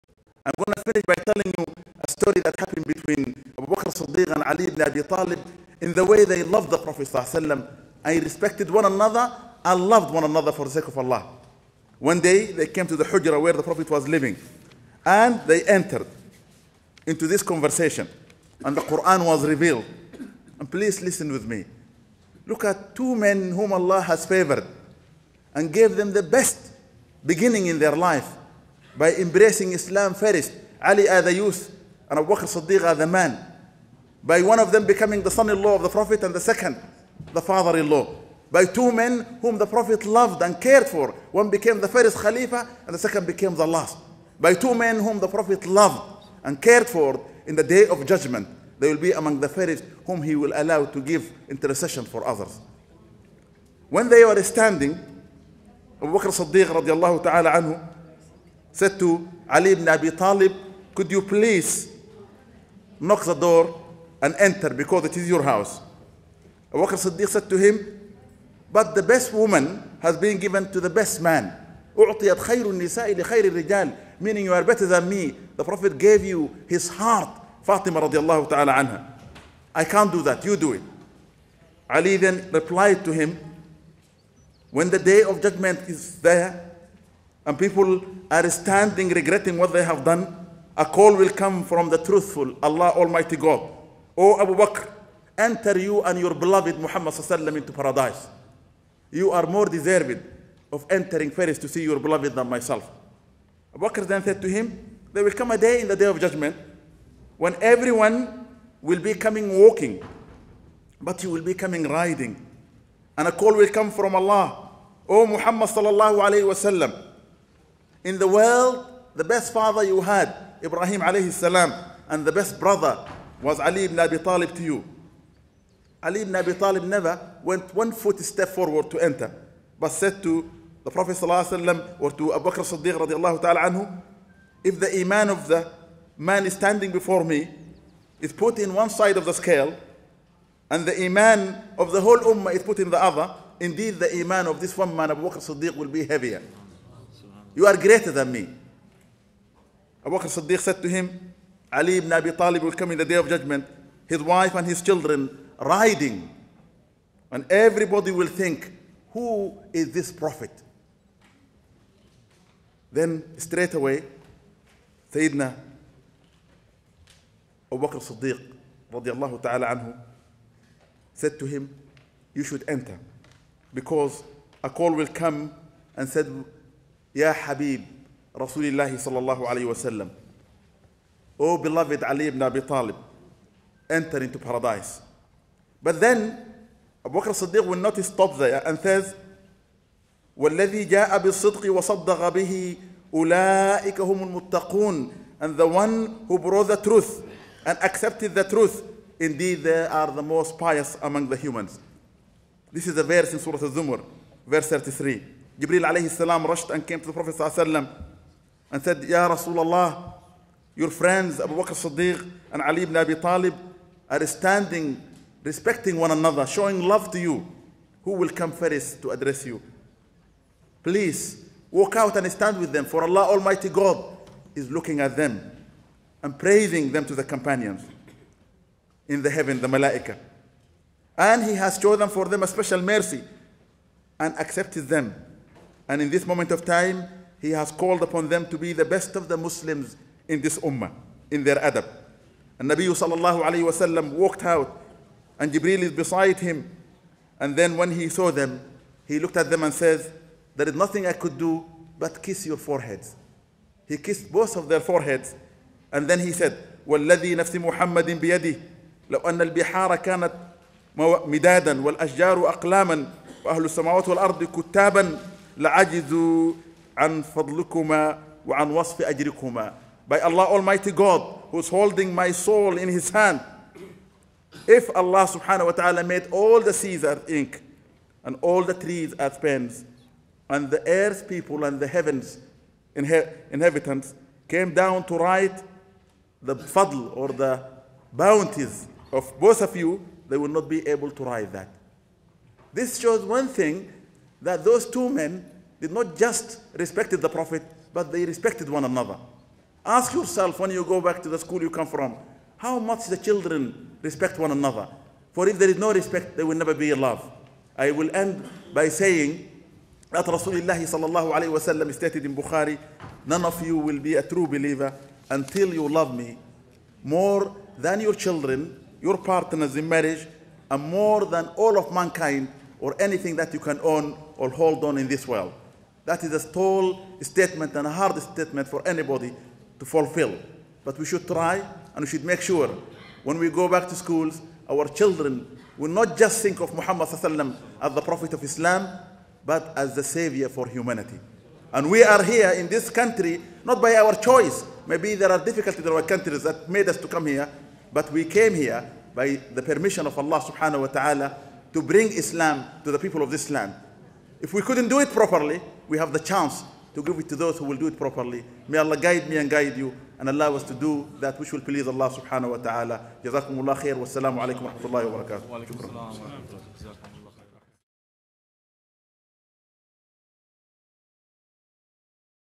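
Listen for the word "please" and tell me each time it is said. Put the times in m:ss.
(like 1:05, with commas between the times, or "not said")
0:20, 1:01, 3:40, 6:01.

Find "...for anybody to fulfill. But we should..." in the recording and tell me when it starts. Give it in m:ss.
5:28.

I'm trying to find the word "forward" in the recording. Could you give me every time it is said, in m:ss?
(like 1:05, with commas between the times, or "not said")
2:08.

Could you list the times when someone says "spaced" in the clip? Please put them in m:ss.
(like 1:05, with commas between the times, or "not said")
not said.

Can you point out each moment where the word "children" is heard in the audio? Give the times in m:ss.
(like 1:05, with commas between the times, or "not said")
2:34, 5:03, 5:18, 5:34.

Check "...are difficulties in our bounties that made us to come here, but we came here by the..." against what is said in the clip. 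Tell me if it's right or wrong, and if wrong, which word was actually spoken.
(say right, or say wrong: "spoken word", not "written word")
wrong: "countries", not "bounties".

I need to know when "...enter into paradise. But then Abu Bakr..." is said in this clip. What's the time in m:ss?
3:03.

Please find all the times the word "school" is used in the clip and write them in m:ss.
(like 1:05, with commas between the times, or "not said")
5:01, 5:33.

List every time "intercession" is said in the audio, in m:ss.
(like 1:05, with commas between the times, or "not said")
0:51.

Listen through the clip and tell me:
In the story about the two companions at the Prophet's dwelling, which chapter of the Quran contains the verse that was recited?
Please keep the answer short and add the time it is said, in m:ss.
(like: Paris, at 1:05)
Surah Al-Zumar, at 3:23.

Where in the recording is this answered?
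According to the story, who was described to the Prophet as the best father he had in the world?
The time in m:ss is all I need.
2:00.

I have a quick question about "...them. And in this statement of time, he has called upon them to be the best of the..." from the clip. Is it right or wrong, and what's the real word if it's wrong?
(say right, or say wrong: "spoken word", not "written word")
wrong: "moment", not "statement".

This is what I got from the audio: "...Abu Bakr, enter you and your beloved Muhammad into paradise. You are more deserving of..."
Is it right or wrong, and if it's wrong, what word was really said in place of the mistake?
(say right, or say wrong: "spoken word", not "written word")
right.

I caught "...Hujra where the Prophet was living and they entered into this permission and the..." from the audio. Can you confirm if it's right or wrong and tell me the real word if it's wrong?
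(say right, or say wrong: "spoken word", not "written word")
wrong: "conversation", not "permission".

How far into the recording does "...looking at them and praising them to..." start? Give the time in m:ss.
3:44.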